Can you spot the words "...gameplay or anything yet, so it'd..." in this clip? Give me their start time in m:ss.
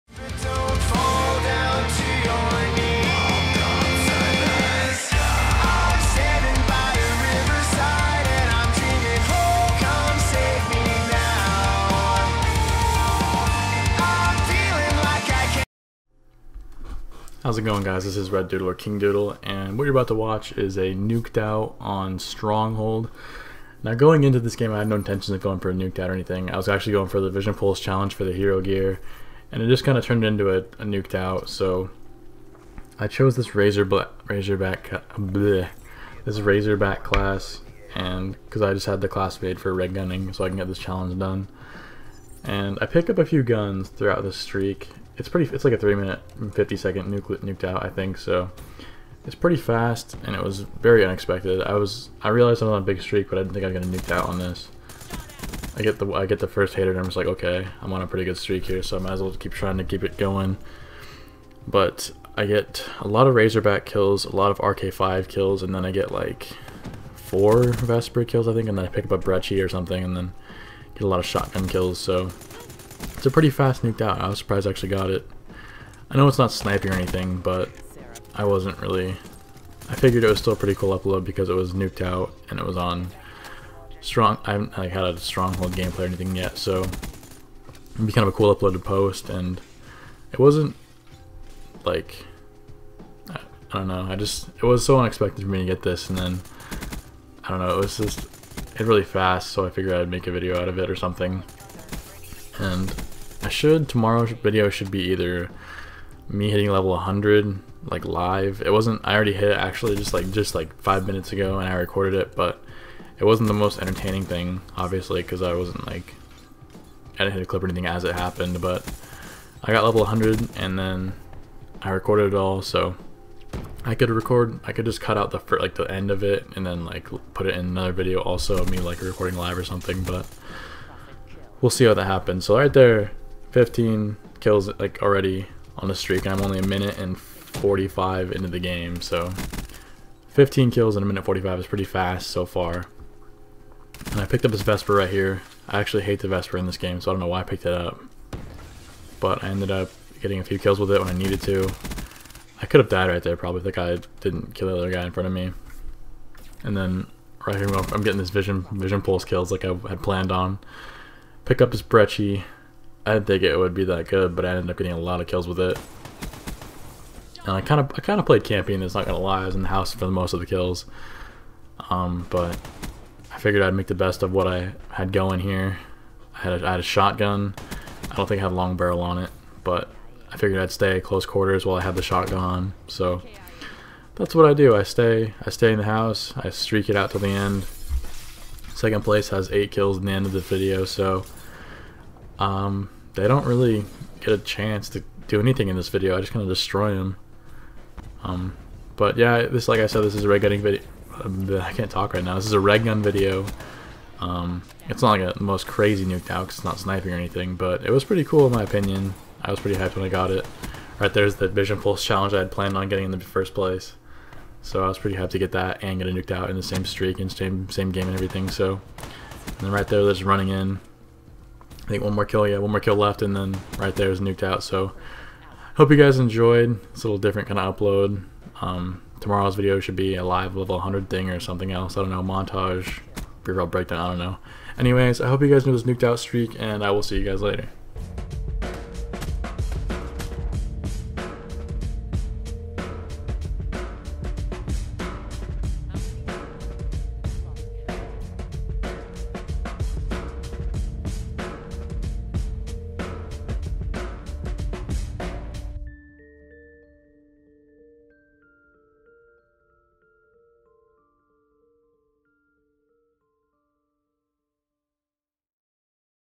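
1:25.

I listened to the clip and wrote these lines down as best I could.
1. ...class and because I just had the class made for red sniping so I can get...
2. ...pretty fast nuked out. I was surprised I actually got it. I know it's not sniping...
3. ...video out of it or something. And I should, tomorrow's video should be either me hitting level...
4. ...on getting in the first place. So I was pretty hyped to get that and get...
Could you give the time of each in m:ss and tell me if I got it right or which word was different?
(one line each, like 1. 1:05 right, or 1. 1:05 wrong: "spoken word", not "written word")
1. 0:37 wrong: "gunning", not "sniping"
2. 1:13 right
3. 1:40 right
4. 3:32 right.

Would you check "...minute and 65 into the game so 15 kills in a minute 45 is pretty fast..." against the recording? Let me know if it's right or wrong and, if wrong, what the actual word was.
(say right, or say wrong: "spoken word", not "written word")
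wrong: "45", not "65".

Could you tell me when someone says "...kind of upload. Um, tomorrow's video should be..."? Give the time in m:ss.
3:47.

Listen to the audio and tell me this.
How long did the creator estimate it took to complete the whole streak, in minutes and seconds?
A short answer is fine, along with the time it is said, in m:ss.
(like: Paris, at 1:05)
3 minutes 50 seconds, at 0:45.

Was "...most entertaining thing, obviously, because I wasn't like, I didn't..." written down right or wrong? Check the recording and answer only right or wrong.
right.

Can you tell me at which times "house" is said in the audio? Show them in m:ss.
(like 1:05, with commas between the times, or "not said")
2:49, 3:05.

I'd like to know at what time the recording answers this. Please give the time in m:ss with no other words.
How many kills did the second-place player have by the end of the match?
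3:09.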